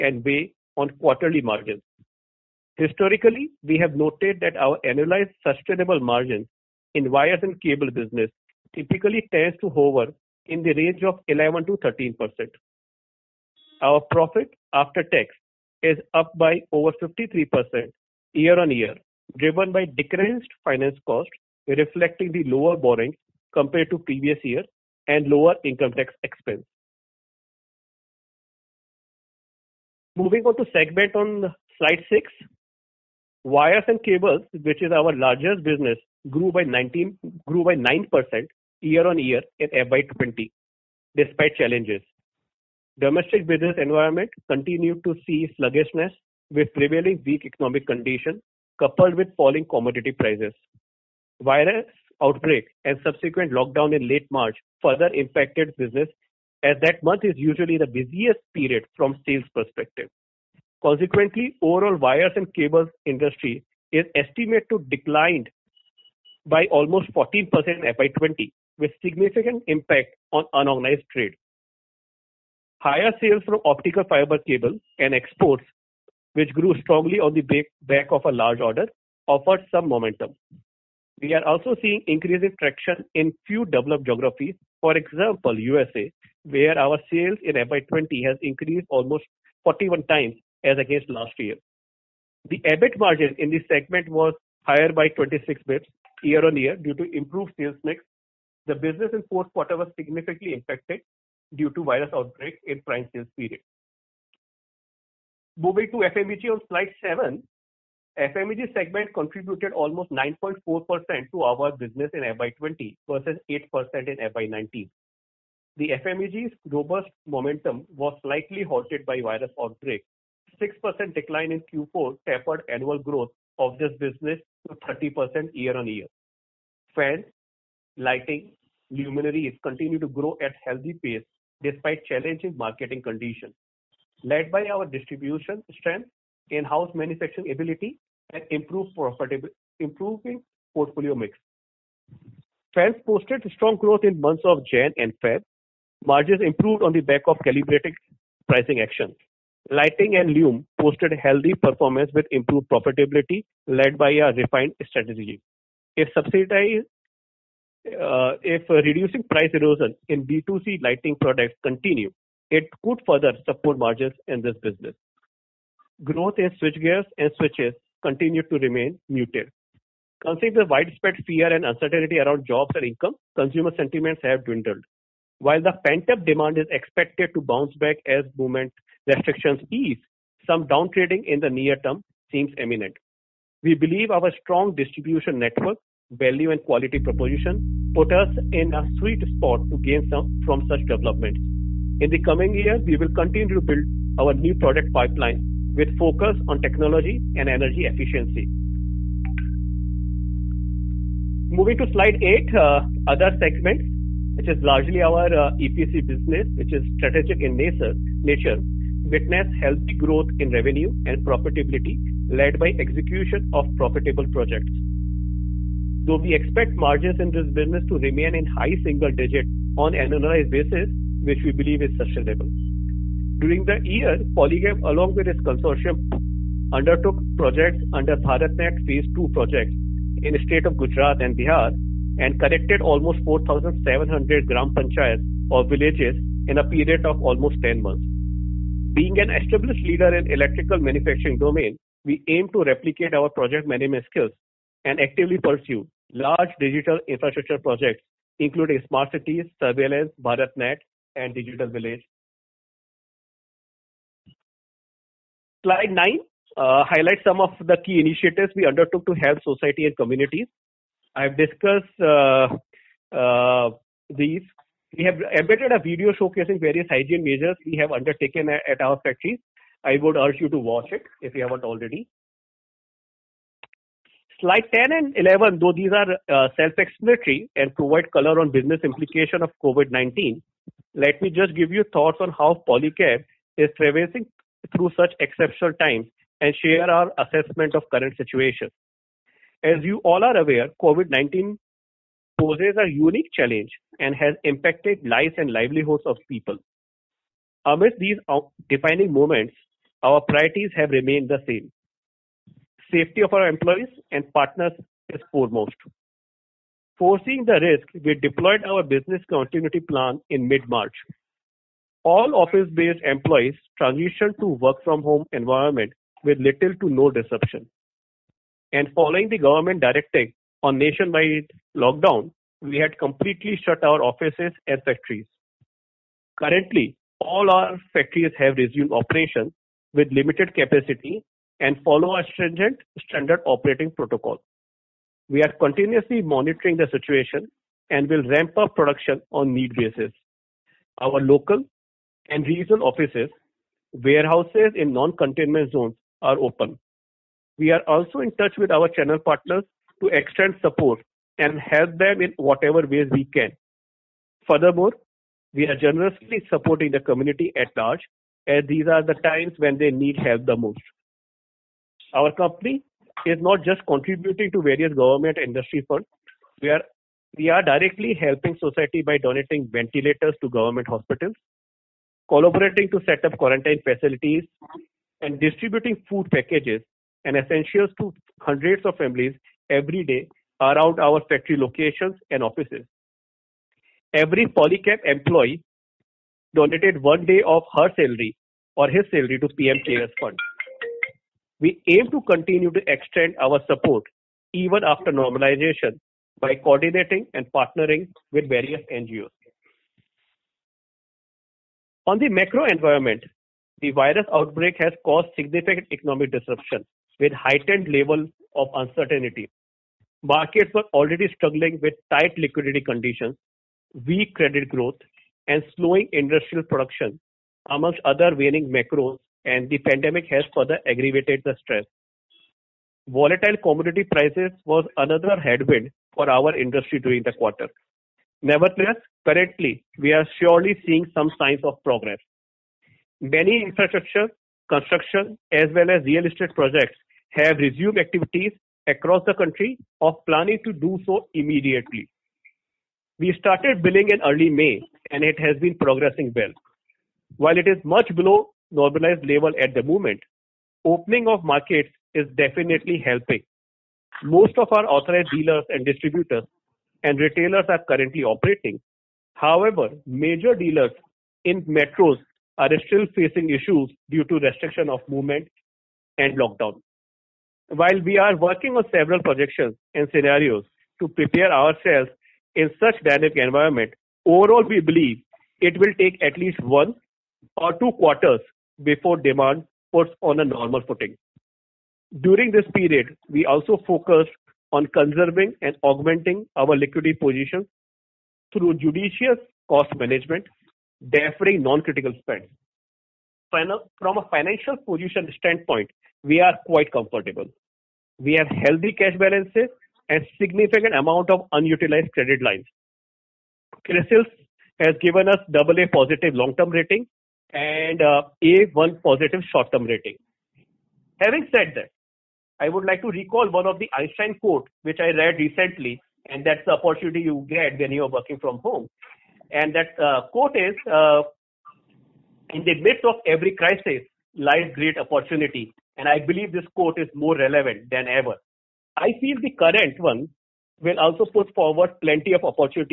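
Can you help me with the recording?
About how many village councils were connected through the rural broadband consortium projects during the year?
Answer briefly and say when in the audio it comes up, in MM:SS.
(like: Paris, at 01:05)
4,700, at 03:53.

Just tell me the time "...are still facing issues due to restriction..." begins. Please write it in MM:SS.
07:42.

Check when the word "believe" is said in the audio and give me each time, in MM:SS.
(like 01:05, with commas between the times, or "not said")
03:03, 03:41, 07:54, 08:46.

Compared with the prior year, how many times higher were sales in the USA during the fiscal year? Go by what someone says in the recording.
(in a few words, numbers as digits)
41 times.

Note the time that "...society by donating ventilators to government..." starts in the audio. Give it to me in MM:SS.
06:08.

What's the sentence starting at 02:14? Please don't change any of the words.
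Led by our distribution strength, in-house manufacturing ability, and improve profitability, improving portfolio mix.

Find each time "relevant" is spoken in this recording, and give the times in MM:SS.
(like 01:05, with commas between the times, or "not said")
08:47.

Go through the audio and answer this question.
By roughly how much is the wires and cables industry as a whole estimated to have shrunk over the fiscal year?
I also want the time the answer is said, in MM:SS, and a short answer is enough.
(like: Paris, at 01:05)
14%, at 01:07.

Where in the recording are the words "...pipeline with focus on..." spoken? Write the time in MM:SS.
03:14.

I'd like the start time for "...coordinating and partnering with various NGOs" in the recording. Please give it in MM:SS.
06:36.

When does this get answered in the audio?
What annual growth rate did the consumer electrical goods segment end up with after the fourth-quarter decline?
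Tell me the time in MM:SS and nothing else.
02:04.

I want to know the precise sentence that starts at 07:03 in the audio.
Volatile commodity prices was another headwind for our industry during the quarter.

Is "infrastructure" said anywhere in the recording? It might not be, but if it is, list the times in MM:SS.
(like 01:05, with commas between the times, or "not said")
04:07, 07:13.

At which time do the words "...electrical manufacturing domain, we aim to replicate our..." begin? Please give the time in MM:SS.
04:00.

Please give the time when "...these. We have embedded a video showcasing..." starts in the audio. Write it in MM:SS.
04:24.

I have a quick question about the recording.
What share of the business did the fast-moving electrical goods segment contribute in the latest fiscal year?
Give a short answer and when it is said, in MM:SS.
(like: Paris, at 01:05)
9.4%, at 01:50.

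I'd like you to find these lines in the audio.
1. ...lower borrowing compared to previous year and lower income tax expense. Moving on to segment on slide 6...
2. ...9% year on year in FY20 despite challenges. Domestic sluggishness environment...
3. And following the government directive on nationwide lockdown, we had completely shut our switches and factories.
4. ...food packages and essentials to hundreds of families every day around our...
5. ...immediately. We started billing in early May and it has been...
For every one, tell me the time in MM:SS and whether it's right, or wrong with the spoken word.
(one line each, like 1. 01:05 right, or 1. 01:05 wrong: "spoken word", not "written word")
1. 00:22 right
2. 00:37 wrong: "business", not "sluggishness"
3. 05:18 wrong: "offices", not "switches"
4. 06:16 right
5. 07:21 right.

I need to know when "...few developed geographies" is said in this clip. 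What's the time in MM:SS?
01:23.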